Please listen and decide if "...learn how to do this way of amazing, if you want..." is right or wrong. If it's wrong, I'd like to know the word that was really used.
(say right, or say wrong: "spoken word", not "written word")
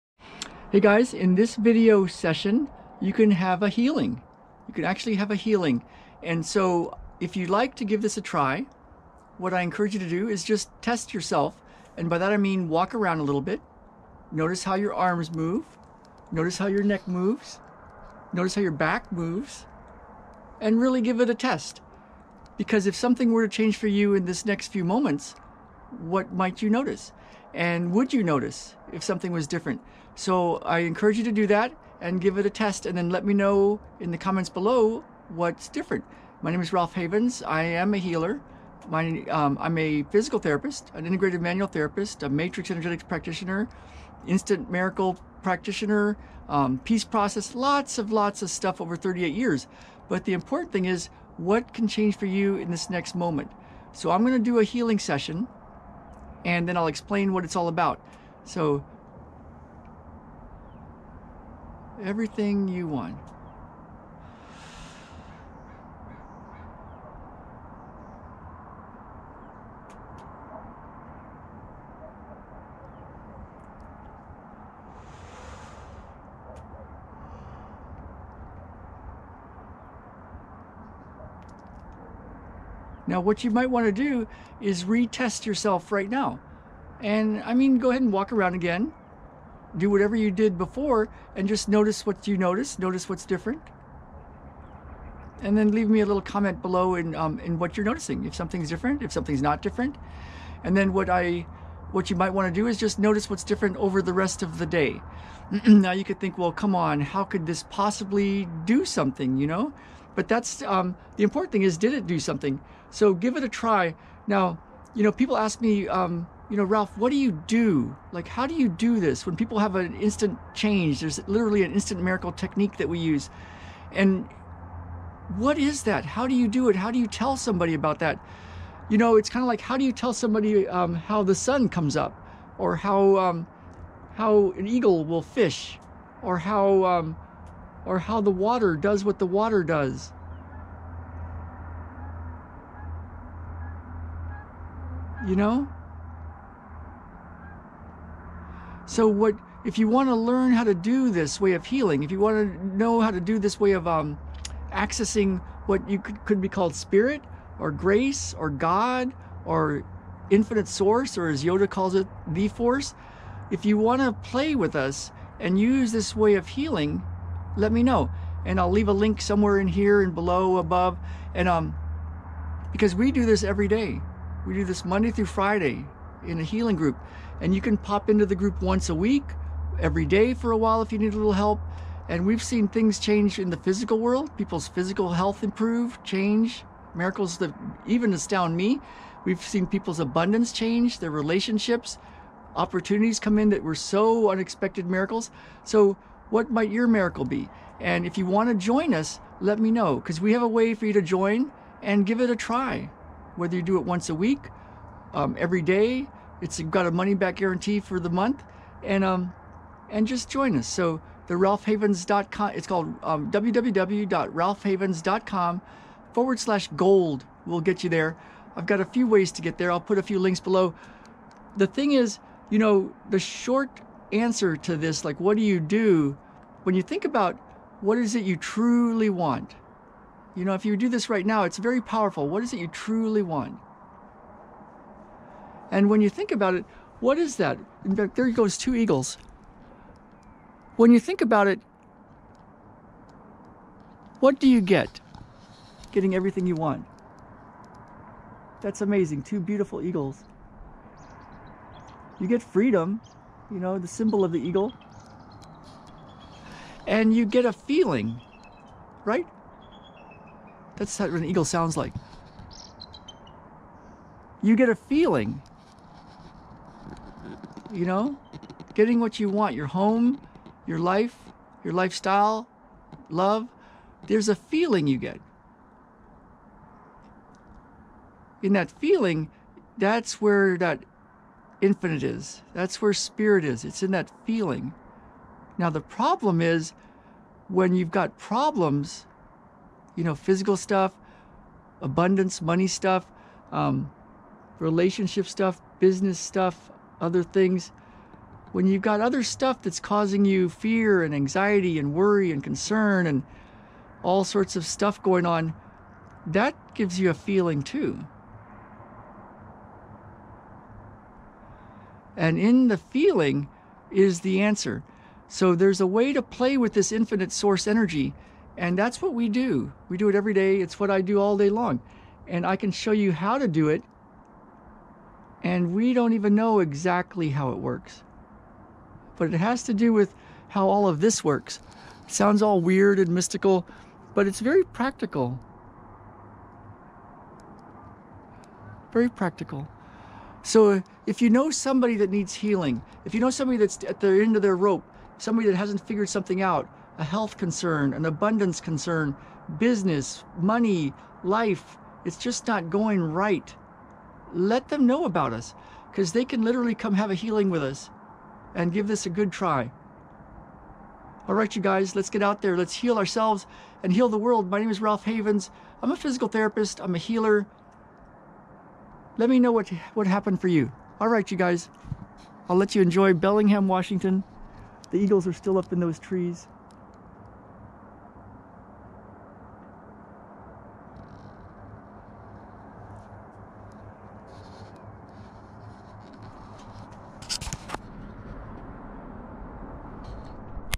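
wrong: "healing", not "amazing".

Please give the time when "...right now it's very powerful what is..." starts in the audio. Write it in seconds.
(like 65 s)
231 s.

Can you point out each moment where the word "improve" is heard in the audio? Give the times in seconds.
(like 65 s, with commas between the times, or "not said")
185 s.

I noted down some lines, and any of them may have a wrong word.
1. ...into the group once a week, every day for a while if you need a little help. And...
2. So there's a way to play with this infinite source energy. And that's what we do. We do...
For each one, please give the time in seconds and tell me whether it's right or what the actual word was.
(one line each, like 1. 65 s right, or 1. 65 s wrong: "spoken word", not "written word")
1. 178 s right
2. 315 s right.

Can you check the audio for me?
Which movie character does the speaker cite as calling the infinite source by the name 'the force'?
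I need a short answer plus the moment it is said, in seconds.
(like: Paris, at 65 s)
Yoda, at 161 s.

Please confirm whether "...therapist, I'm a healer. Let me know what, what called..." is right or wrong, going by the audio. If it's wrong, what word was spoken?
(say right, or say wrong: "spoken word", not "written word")
wrong: "happened", not "called".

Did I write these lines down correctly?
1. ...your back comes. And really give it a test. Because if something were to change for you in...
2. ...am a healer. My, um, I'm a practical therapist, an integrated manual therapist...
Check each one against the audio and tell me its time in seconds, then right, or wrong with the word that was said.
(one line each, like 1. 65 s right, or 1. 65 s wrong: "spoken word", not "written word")
1. 18 s wrong: "moves", not "comes"
2. 37 s wrong: "physical", not "practical".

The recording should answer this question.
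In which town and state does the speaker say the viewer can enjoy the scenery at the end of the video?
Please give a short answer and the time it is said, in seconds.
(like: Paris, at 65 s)
Bellingham, Washington, at 373 s.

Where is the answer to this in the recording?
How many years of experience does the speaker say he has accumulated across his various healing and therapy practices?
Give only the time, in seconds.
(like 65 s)
48 s.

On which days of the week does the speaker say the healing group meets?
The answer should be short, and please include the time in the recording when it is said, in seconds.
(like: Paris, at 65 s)
Monday through Friday, at 174 s.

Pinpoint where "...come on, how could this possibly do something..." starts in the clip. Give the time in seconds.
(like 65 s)
106 s.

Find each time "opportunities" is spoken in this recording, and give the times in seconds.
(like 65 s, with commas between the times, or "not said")
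192 s.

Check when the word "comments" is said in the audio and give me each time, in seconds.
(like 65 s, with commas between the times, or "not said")
34 s, 96 s.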